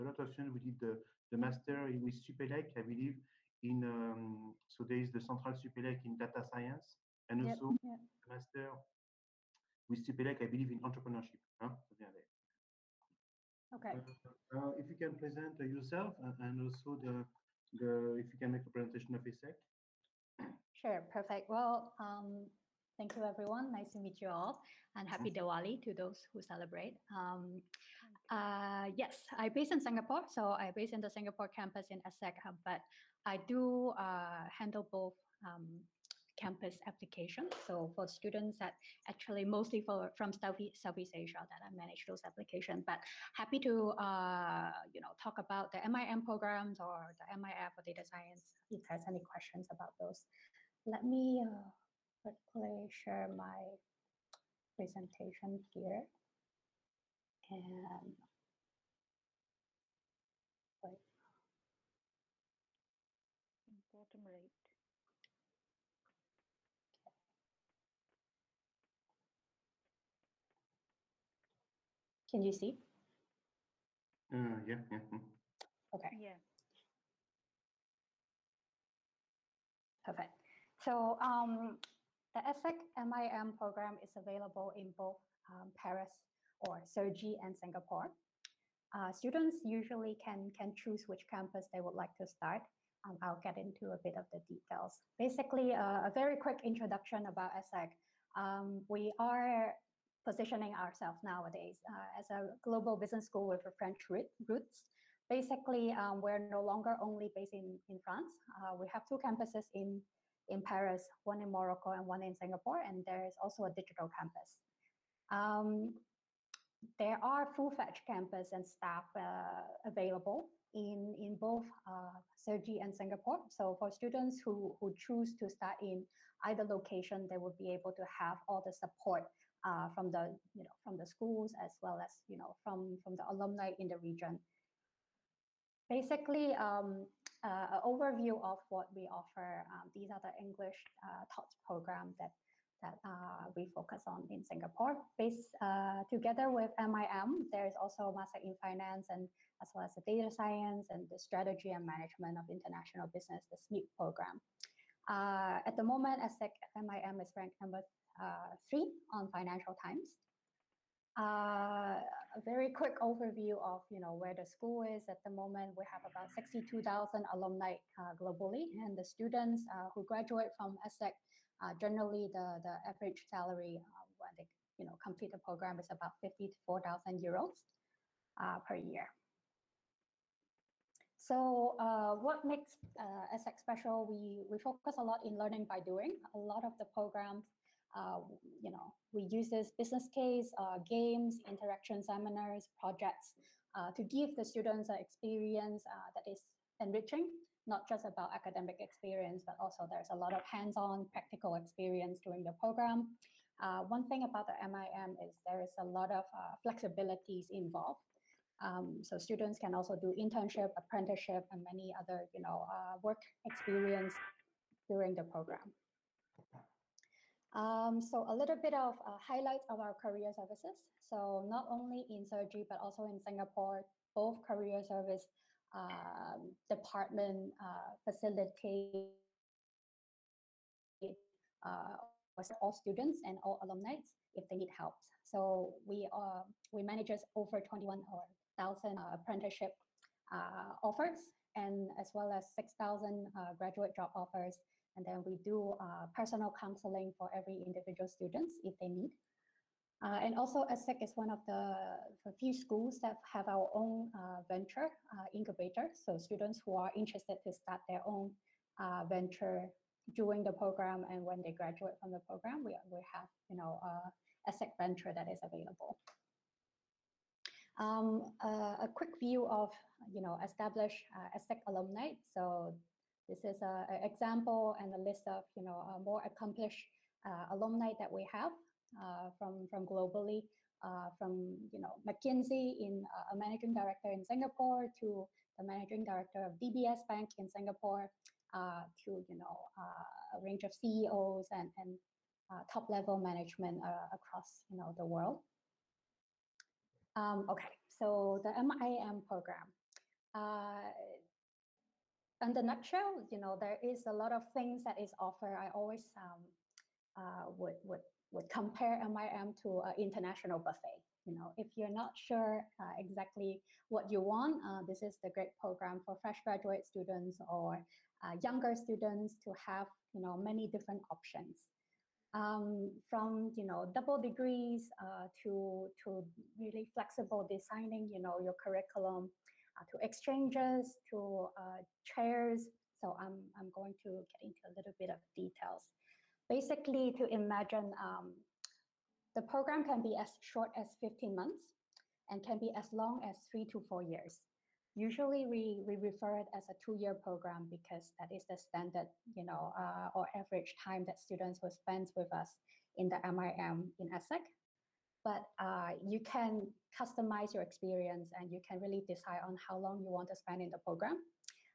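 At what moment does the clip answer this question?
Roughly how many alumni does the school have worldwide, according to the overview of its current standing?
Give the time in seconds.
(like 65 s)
166 s.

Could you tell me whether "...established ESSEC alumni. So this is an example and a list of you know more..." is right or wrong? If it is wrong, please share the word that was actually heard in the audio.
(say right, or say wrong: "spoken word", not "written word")
right.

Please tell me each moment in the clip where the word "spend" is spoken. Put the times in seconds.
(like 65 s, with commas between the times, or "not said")
351 s, 360 s.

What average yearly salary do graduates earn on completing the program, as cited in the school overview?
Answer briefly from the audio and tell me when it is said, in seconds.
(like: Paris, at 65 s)
54,000 euros, at 176 s.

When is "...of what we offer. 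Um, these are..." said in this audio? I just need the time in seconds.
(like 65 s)
138 s.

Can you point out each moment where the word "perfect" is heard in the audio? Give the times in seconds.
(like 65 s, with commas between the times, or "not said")
21 s, 80 s.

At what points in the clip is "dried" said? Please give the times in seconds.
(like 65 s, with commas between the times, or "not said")
not said.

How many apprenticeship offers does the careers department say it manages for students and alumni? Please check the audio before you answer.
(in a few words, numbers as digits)
21,000.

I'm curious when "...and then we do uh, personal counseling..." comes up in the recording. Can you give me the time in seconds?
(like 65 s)
244 s.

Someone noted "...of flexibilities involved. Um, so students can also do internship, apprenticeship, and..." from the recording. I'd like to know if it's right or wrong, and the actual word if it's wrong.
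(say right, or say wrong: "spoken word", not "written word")
right.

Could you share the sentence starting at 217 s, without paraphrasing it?
Um, so a little bit of uh, highlights of our career services.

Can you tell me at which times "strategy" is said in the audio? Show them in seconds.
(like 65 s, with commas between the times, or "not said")
151 s.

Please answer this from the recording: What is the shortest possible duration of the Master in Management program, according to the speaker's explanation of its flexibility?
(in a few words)
15 months.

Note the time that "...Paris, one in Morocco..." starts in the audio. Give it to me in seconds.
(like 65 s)
110 s.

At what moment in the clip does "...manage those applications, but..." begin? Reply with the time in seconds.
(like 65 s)
41 s.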